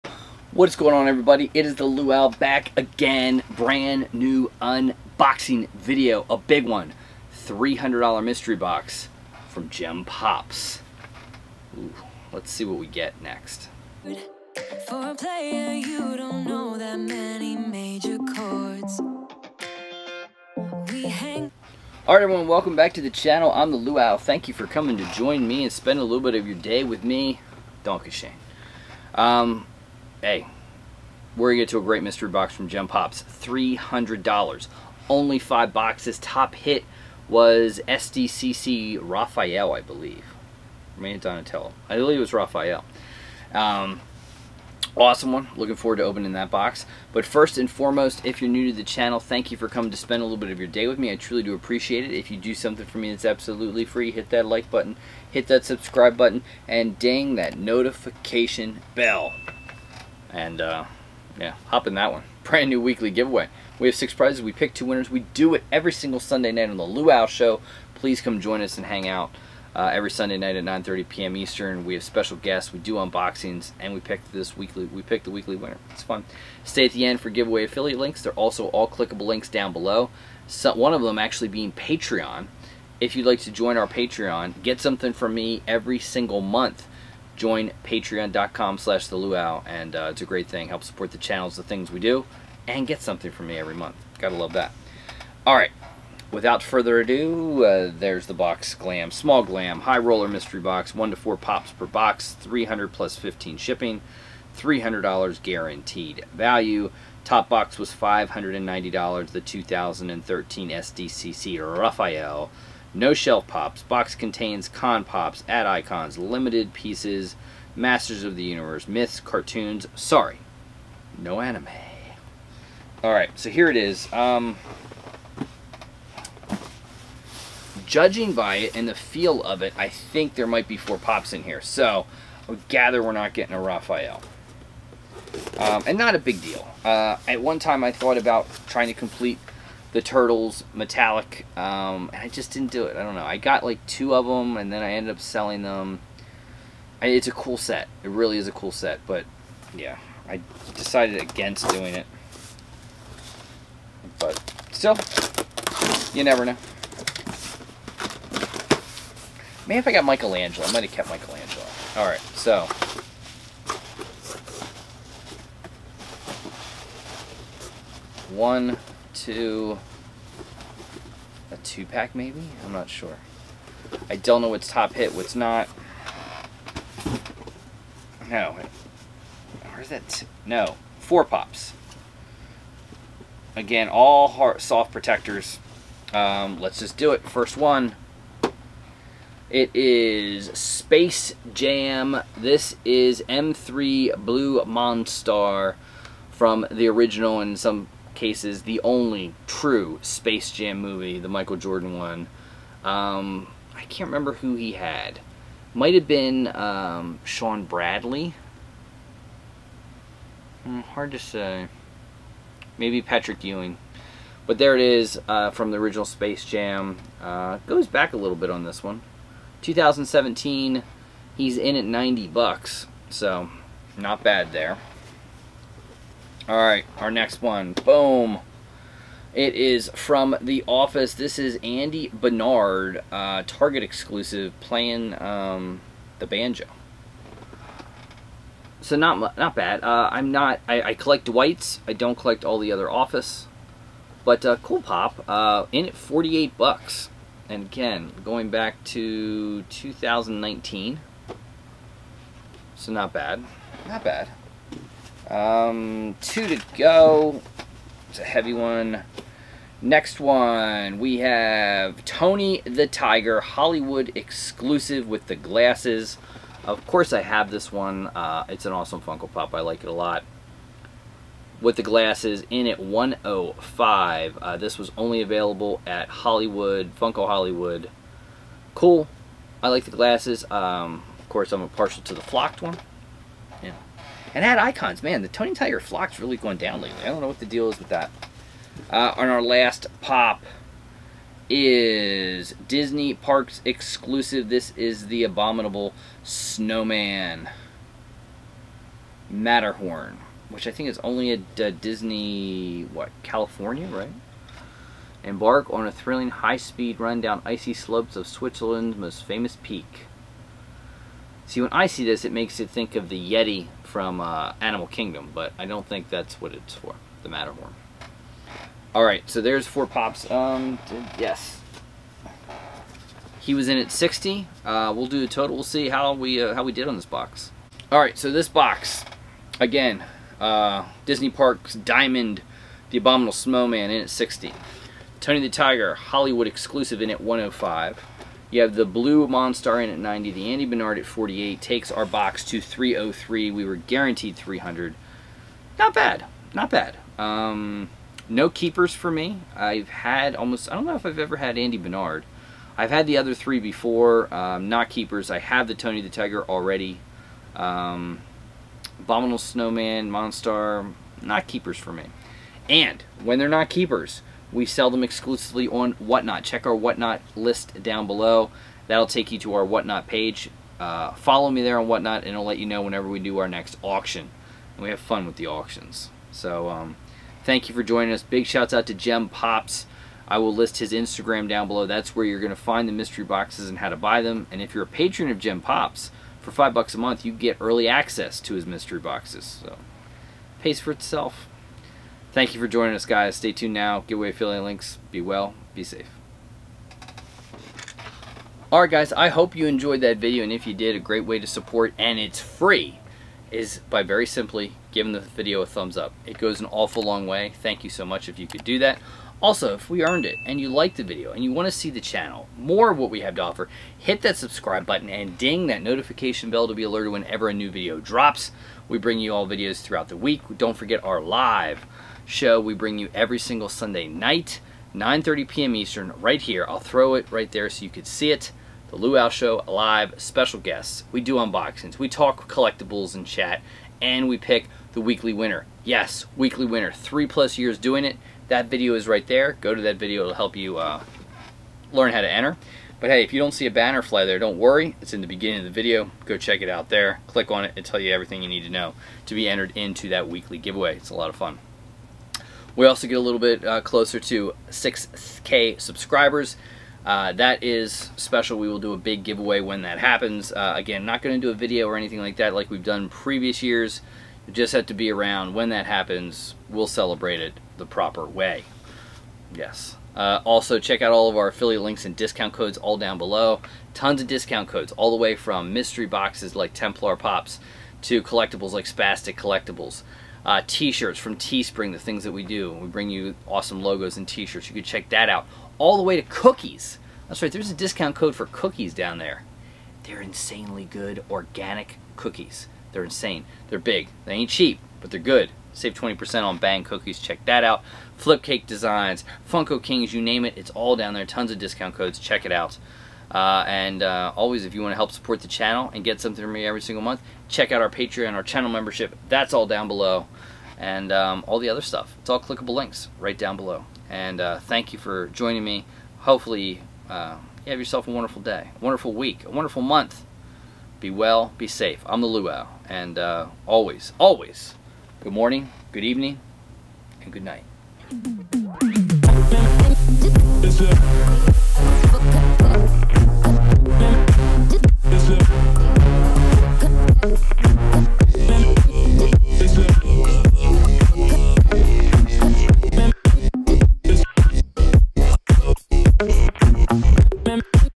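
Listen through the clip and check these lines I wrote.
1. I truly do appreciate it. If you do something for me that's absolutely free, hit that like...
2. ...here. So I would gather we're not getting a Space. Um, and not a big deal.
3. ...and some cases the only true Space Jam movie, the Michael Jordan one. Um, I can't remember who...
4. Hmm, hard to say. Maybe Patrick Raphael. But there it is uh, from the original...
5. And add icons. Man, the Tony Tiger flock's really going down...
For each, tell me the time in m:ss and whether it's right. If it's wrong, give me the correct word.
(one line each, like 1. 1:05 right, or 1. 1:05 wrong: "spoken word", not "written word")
1. 0:51 right
2. 2:11 wrong: "Raphael", not "Space"
3. 3:17 right
4. 3:30 wrong: "Ewing", not "Raphael"
5. 4:44 right.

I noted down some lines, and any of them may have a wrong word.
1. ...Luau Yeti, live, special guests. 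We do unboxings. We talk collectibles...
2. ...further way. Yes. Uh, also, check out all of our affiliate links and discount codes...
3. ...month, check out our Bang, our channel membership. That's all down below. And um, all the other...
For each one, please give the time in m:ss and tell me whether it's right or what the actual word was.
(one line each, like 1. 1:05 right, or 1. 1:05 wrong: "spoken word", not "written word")
1. 7:08 wrong: "Show", not "Yeti"
2. 7:47 wrong: "proper", not "further"
3. 8:27 wrong: "Patreon", not "Bang".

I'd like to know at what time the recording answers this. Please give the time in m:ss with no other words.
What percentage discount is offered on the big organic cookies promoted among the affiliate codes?
8:15.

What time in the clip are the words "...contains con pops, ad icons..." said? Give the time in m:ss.
1:54.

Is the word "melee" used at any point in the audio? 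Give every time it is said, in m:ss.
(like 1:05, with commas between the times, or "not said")
not said.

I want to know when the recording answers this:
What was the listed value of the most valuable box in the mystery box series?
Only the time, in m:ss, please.
1:47.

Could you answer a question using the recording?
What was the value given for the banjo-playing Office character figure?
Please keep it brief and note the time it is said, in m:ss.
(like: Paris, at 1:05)
$48, at 4:05.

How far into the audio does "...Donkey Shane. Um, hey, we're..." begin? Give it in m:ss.
0:27.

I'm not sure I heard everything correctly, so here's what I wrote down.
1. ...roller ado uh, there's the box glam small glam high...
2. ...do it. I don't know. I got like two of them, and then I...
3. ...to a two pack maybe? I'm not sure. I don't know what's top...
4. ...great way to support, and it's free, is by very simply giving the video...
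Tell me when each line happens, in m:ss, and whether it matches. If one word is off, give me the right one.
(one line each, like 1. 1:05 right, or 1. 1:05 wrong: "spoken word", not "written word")
1. 1:36 wrong: "further", not "roller"
2. 2:22 right
3. 2:49 right
4. 6:40 right.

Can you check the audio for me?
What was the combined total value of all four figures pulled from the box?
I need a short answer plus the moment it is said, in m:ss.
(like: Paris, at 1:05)
$303, at 5:42.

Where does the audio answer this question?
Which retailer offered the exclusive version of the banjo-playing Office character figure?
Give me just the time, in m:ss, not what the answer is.
3:53.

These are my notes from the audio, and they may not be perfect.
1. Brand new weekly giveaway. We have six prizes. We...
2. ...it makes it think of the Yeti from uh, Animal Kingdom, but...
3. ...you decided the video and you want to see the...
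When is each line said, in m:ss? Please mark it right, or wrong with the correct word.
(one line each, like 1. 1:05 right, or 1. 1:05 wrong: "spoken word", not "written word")
1. 1:02 right
2. 5:12 right
3. 6:50 wrong: "liked", not "decided".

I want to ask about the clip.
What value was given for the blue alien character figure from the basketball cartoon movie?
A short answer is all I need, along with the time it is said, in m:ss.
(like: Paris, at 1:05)
$90, at 3:41.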